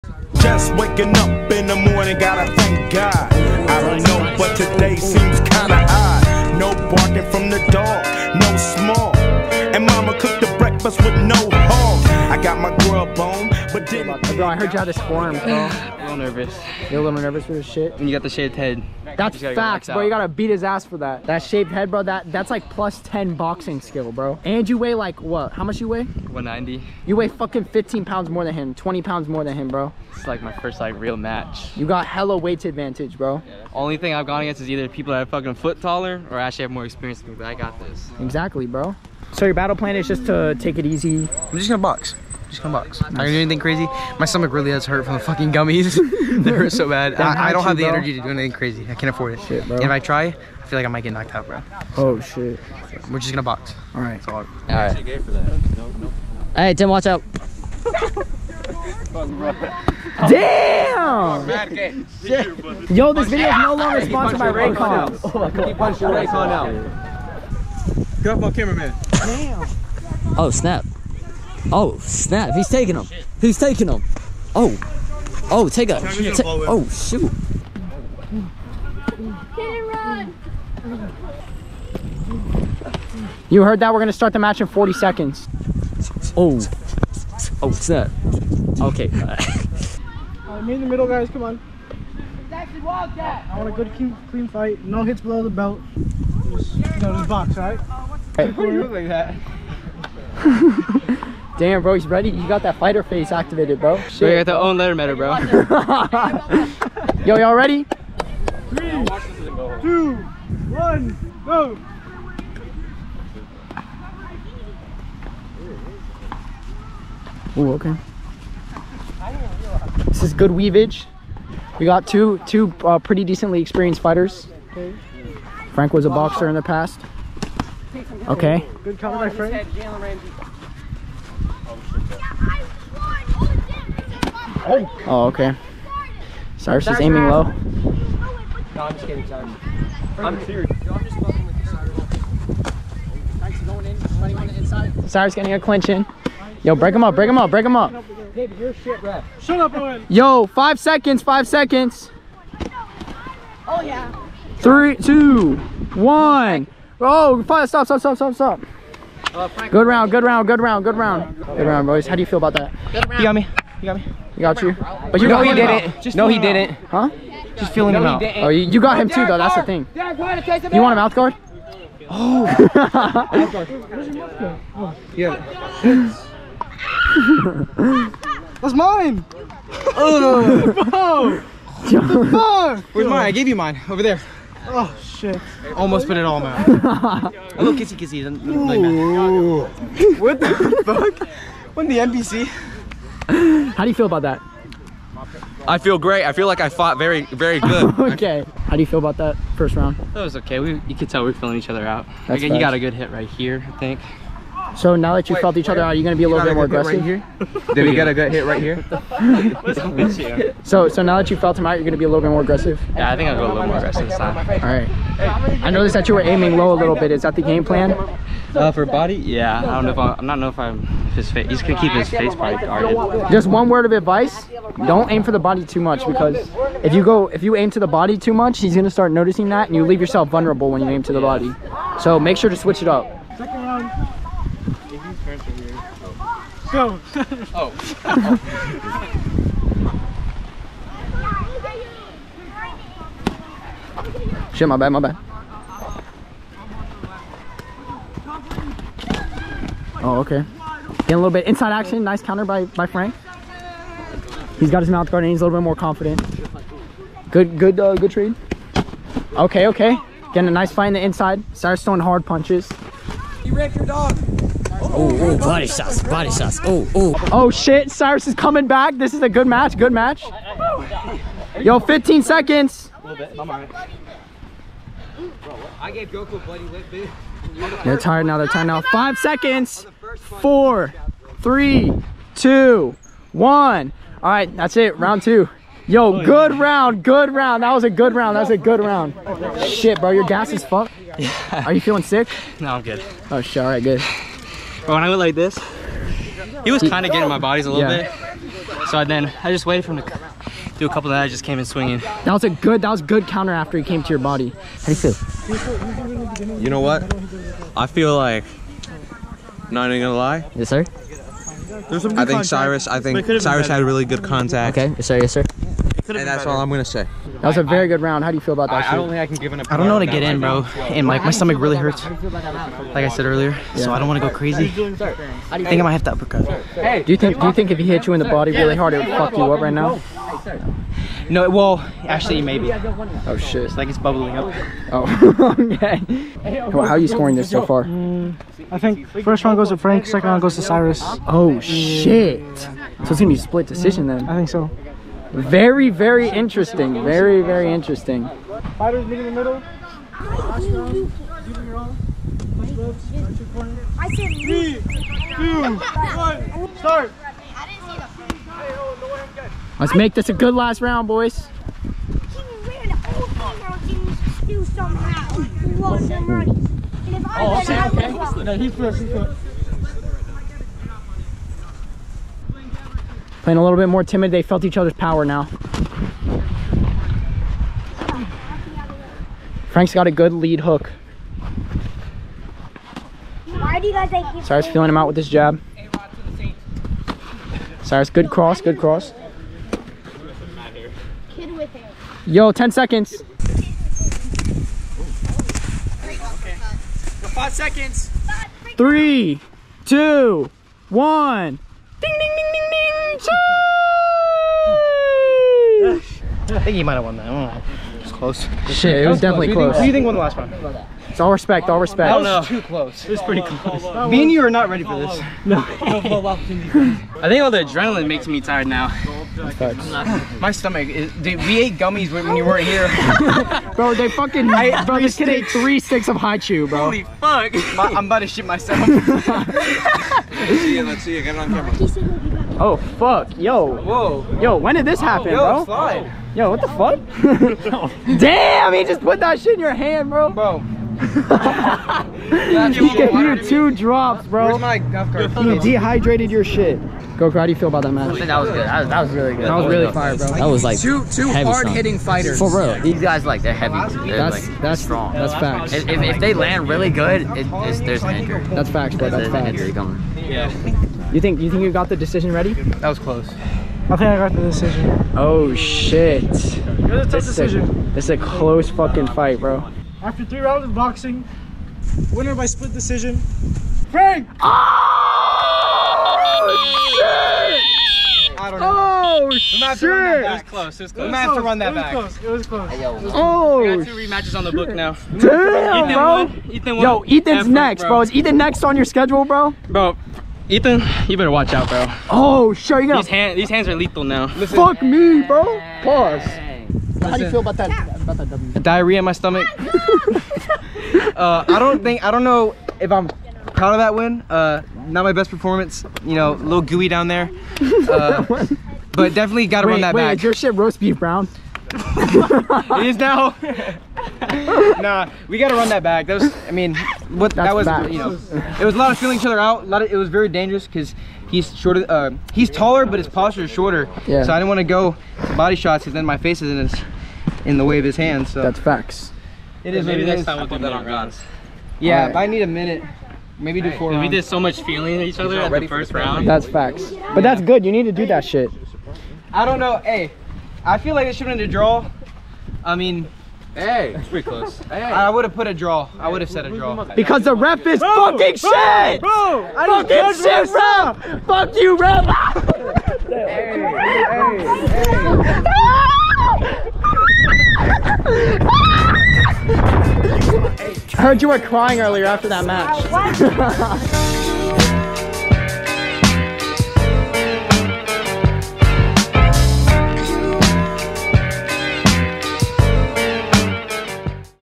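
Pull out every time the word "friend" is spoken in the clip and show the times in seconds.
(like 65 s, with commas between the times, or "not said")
129 s.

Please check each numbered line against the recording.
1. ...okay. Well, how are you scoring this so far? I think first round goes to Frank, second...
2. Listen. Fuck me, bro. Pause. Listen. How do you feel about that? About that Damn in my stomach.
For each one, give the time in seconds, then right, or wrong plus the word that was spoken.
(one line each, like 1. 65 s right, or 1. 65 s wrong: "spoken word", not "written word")
1. 335 s right
2. 494 s wrong: "Diarrhea", not "Damn".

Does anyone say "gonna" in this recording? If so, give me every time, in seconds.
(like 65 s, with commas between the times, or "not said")
41 s, 53 s, 310 s, 316 s, 343 s.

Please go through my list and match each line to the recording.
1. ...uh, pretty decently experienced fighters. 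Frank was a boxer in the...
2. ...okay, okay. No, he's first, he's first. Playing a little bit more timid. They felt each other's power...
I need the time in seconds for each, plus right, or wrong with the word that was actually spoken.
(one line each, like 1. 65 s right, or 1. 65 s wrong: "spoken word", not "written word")
1. 122 s right
2. 367 s right.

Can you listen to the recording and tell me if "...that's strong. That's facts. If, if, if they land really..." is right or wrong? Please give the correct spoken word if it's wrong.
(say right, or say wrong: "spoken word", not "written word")
right.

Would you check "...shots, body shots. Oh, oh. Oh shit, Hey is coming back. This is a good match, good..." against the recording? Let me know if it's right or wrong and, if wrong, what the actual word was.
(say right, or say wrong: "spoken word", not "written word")
wrong: "Cyrus", not "Hey".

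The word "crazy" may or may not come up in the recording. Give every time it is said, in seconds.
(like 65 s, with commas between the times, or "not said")
43 s, 48 s, 324 s.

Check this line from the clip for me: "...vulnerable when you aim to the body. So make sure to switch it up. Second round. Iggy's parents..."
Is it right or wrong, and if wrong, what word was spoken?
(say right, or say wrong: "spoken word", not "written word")
right.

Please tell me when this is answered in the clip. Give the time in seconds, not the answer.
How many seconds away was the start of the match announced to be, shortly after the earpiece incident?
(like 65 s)
84 s.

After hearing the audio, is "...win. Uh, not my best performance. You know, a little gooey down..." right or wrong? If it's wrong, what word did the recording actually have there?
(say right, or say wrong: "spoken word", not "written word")
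right.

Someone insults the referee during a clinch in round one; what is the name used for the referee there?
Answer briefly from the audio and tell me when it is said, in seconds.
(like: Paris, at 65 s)
David, at 148 s.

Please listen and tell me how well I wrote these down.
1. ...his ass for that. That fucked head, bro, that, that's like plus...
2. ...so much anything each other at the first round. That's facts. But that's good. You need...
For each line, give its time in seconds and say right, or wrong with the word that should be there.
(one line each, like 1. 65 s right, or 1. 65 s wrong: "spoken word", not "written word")
1. 20 s wrong: "shaved", not "fucked"
2. 534 s wrong: "feeling", not "anything".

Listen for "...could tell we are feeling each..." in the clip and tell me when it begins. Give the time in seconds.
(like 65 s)
200 s.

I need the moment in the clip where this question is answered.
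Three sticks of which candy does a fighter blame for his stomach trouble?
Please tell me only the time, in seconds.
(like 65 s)
426 s.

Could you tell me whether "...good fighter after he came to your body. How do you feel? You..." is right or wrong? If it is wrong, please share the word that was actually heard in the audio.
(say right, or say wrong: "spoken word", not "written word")
wrong: "counter", not "fighter".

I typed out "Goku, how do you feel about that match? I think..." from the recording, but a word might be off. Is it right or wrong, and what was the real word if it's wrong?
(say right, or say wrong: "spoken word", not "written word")
right.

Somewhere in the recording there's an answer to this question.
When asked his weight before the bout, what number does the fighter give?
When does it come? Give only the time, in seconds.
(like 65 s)
26 s.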